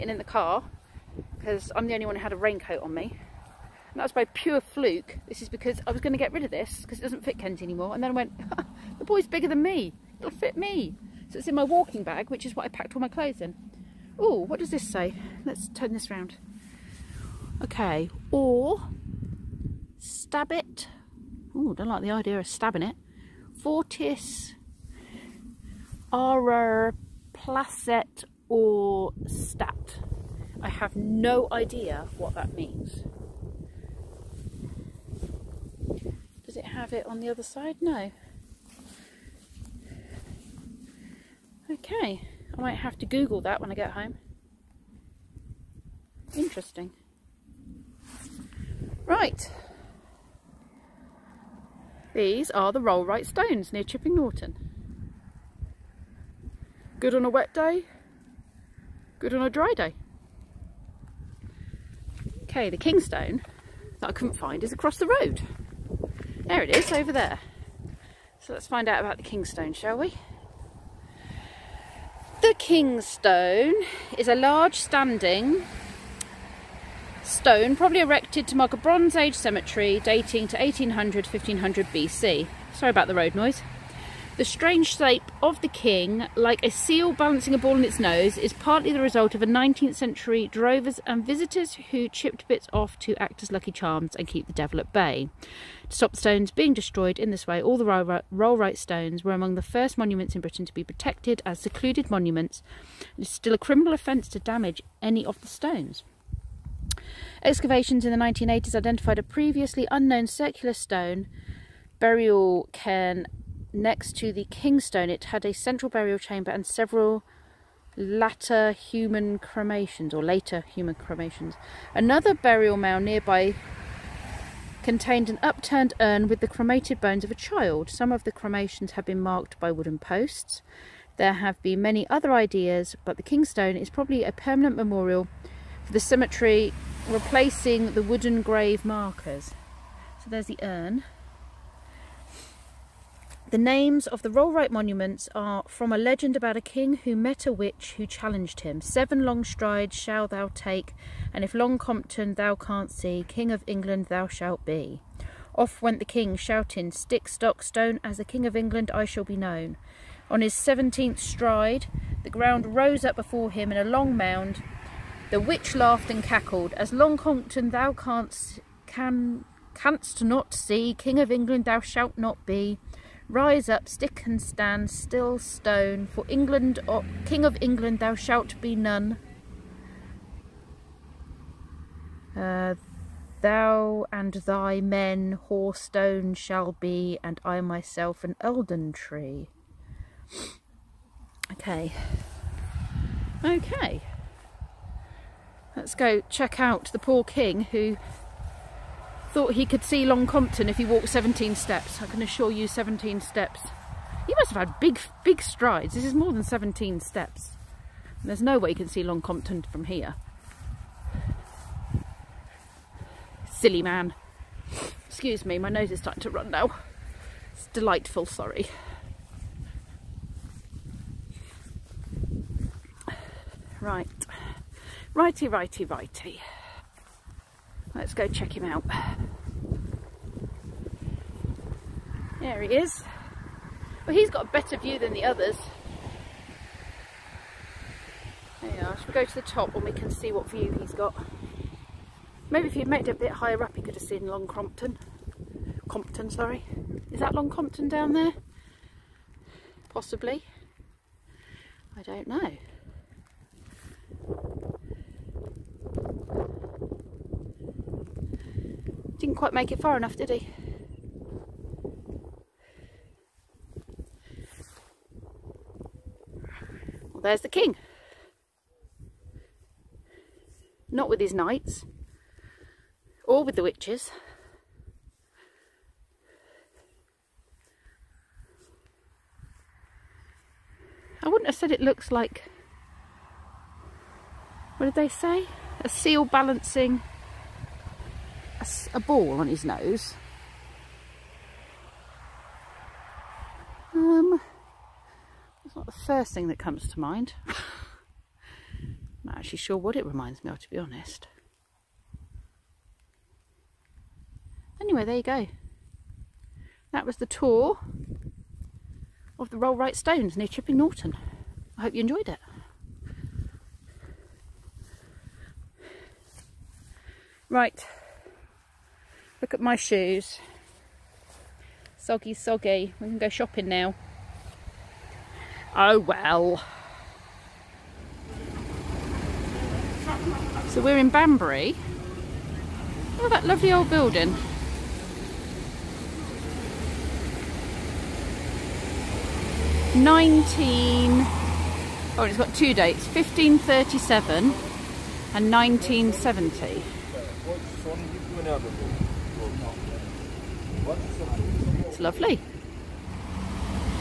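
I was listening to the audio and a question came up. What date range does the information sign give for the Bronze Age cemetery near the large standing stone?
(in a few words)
1800-1500 BC.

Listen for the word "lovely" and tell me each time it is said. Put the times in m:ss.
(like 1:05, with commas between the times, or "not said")
5:33, 5:51.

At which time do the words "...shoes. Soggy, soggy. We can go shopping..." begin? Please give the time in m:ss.
5:19.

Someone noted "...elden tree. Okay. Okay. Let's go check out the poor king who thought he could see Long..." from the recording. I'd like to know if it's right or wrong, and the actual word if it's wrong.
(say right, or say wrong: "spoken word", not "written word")
right.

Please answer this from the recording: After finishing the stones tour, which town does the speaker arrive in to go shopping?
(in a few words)
Banbury.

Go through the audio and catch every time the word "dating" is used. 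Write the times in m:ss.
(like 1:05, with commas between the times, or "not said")
1:20.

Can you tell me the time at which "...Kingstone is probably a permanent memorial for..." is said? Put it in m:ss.
2:13.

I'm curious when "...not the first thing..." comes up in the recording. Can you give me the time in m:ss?
4:55.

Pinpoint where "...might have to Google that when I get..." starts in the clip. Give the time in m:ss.
0:42.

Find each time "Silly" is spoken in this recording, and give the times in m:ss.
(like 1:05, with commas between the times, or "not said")
3:33.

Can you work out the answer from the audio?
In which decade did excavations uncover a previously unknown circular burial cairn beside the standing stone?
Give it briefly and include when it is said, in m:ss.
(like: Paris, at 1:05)
1980s, at 1:48.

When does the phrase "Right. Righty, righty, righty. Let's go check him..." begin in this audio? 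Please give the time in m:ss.
3:43.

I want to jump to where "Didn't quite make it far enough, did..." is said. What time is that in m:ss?
4:19.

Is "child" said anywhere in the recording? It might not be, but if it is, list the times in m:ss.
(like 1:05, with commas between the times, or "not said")
2:07.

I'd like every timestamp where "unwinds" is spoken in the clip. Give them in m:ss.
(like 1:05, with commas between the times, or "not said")
not said.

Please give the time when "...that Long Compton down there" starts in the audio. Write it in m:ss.
4:07.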